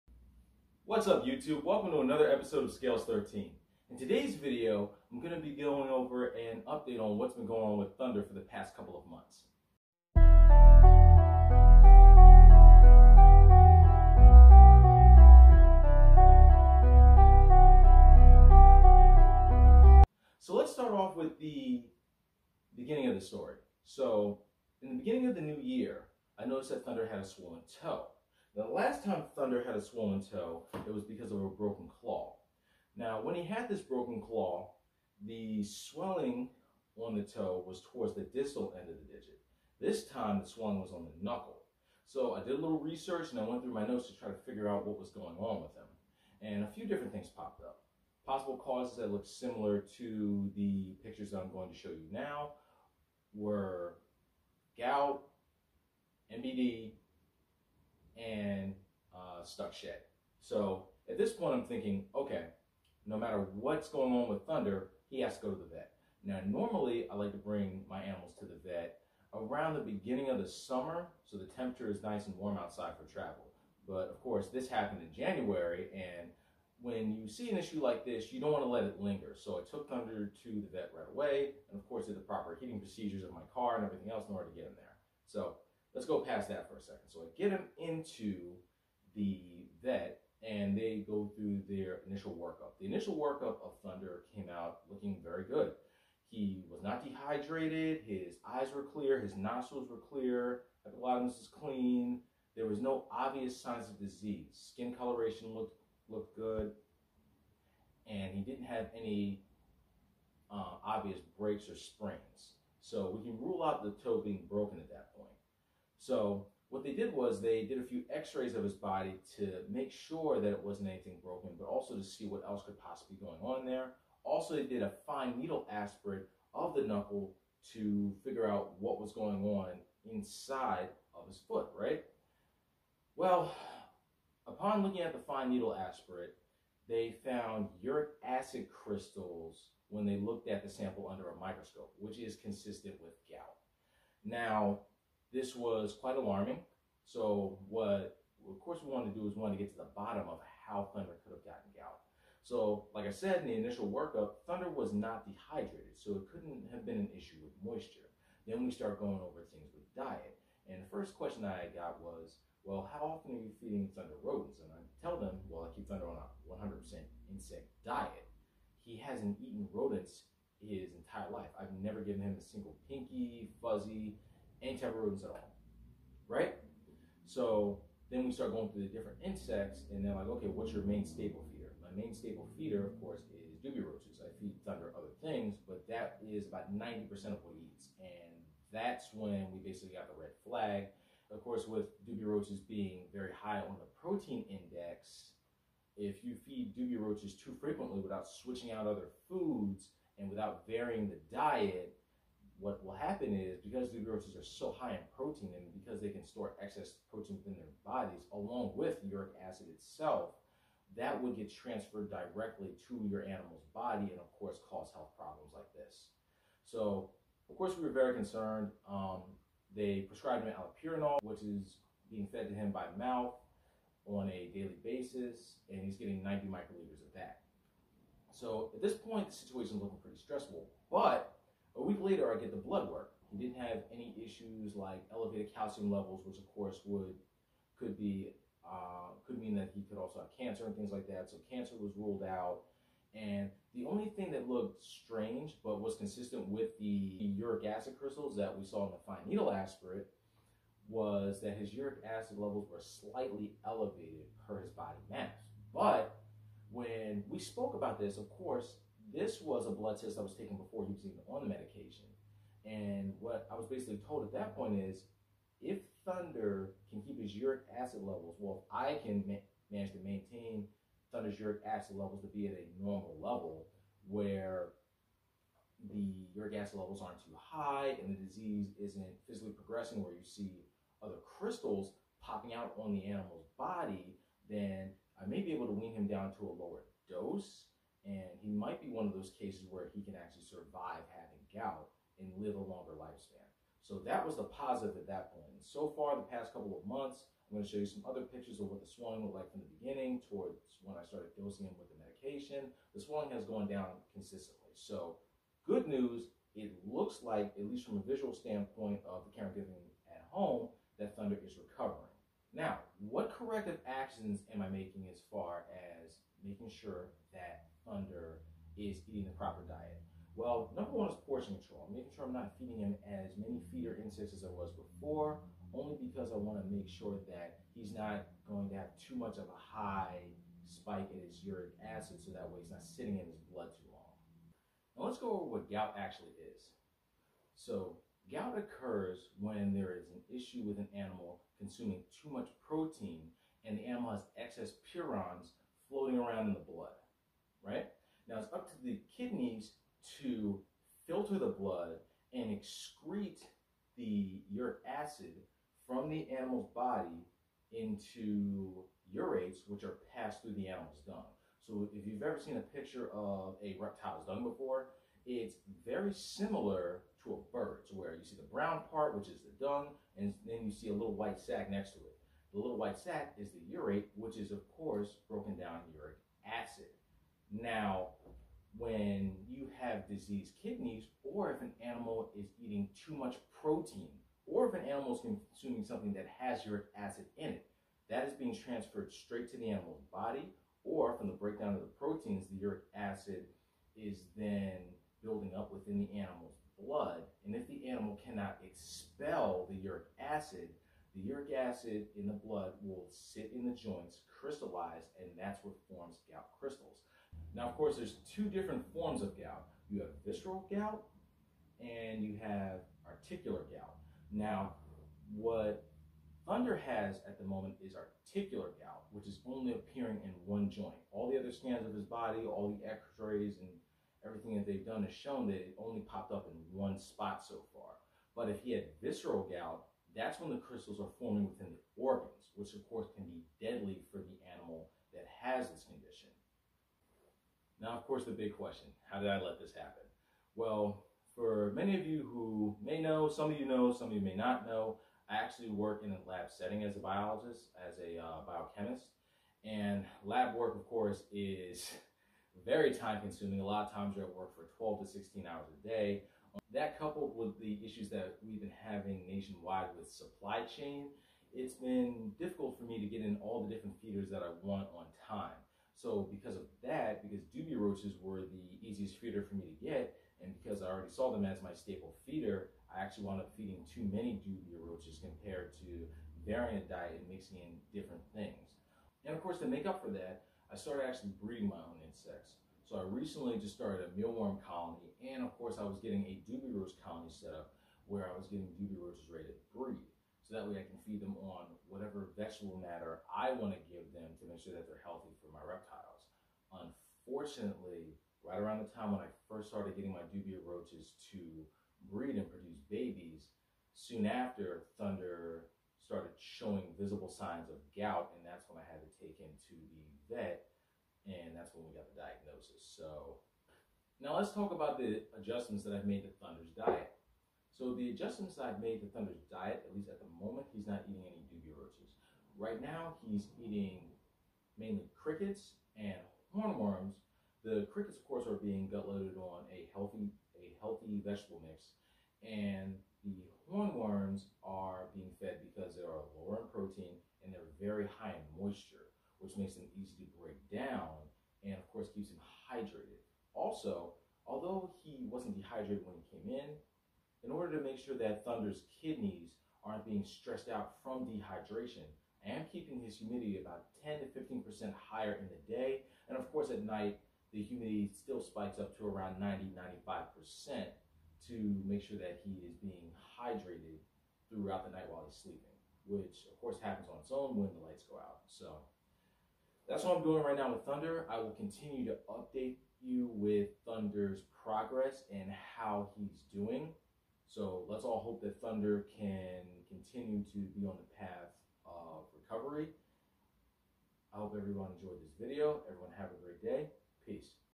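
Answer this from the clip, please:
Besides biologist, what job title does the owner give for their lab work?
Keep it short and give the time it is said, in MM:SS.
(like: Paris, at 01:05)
biochemist, at 07:28.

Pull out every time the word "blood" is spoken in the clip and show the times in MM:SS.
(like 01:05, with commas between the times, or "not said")
03:52, 04:19, 05:33, 05:46, 05:51, 06:36, 06:42.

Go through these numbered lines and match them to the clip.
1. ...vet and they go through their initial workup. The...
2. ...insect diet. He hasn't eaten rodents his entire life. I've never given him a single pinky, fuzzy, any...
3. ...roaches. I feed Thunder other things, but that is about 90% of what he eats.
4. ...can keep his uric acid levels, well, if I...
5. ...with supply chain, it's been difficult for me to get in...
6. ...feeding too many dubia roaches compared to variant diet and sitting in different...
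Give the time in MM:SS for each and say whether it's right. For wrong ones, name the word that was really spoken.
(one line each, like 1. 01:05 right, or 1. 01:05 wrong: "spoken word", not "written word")
1. 01:29 right
2. 02:47 right
3. 03:03 right
4. 04:26 right
5. 07:39 right
6. 07:53 wrong: "mixing", not "sitting".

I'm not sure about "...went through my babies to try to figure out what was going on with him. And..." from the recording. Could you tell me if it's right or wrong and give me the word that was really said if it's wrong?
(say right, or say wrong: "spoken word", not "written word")
wrong: "notes", not "babies".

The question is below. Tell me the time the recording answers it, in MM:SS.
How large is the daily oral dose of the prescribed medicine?
03:46.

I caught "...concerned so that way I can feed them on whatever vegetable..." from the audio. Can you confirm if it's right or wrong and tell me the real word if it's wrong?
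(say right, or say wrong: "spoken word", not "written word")
wrong: "breed", not "concerned".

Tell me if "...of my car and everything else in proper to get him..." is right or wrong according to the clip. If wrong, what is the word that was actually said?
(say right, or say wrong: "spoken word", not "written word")
wrong: "order", not "proper".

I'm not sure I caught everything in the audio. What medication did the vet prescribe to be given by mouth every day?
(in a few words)
allopurinol.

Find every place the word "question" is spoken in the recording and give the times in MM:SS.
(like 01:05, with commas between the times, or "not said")
02:41, 07:18.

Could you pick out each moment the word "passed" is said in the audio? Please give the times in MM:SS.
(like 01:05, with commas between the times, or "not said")
06:00.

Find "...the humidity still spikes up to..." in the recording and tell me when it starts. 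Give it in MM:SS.
09:17.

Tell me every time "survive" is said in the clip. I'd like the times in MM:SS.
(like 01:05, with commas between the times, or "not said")
04:50.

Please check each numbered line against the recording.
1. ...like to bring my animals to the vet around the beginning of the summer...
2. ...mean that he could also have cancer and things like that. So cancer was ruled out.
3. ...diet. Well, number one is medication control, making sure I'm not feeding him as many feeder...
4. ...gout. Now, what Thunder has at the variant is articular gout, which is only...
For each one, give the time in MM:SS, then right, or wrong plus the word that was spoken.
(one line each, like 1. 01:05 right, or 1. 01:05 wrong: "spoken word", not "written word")
1. 01:07 right
2. 03:59 right
3. 05:19 wrong: "portion", not "medication"
4. 06:53 wrong: "moment", not "variant".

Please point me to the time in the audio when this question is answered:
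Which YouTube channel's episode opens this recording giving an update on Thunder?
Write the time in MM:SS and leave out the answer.
00:02.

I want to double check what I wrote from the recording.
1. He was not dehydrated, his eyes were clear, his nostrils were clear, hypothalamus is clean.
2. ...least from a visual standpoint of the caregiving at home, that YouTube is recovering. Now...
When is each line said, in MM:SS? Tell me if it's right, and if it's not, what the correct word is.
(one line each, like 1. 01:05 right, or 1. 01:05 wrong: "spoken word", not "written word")
1. 01:36 right
2. 05:07 wrong: "Thunder", not "YouTube".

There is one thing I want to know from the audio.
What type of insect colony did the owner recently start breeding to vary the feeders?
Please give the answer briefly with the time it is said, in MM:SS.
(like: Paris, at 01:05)
mealworm, at 08:04.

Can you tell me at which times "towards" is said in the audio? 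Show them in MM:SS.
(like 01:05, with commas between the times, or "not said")
00:37, 05:00.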